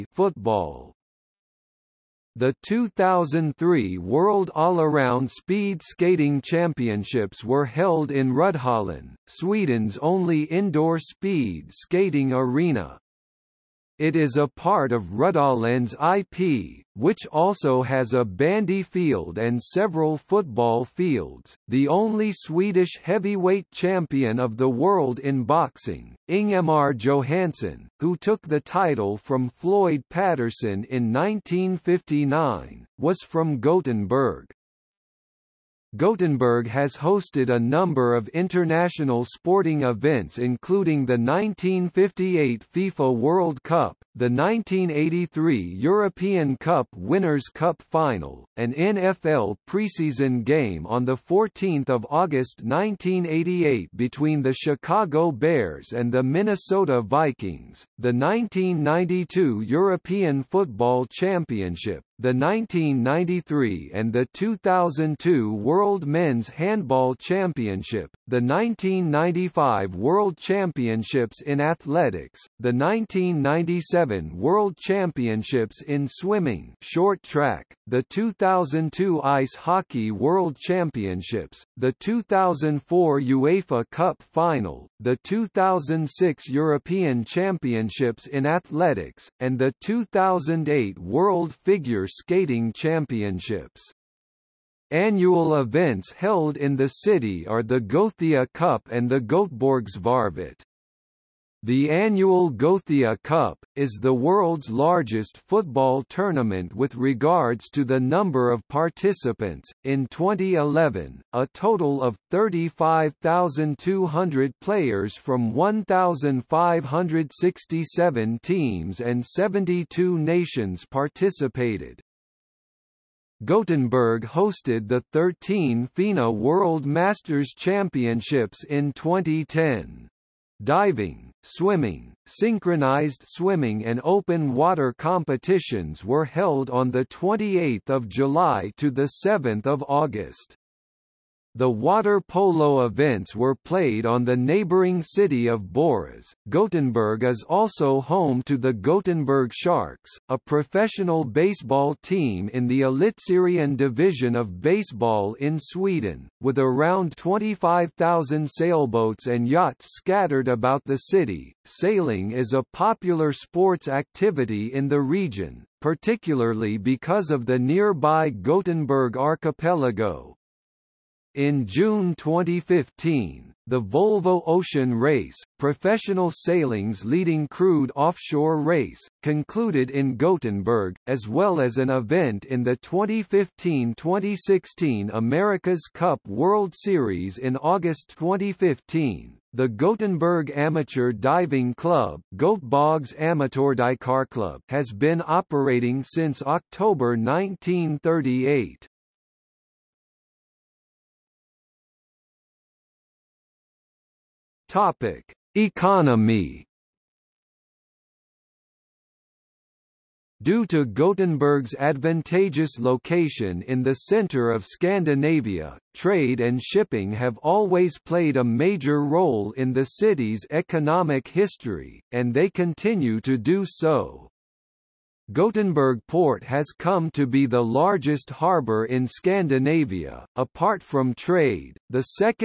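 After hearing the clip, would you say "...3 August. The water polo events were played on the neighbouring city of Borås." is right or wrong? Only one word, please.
wrong.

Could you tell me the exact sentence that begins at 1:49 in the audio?
In 2011, a total of 35,200 players from 1,567 teams and 72 nations participated.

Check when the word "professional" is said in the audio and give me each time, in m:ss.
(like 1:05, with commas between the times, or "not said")
2:30, 2:55.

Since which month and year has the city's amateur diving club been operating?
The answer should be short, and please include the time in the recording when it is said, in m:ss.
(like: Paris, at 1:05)
October 1938, at 3:16.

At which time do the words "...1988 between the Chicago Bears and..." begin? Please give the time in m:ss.
0:52.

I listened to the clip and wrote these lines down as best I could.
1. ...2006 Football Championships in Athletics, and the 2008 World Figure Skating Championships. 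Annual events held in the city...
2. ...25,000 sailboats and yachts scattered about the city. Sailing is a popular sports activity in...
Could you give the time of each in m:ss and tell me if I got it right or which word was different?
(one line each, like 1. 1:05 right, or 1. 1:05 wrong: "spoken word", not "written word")
1. 1:25 wrong: "European", not "Football"
2. 2:37 right.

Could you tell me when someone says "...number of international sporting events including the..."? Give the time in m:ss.
0:37.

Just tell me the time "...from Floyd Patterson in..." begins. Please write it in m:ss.
0:29.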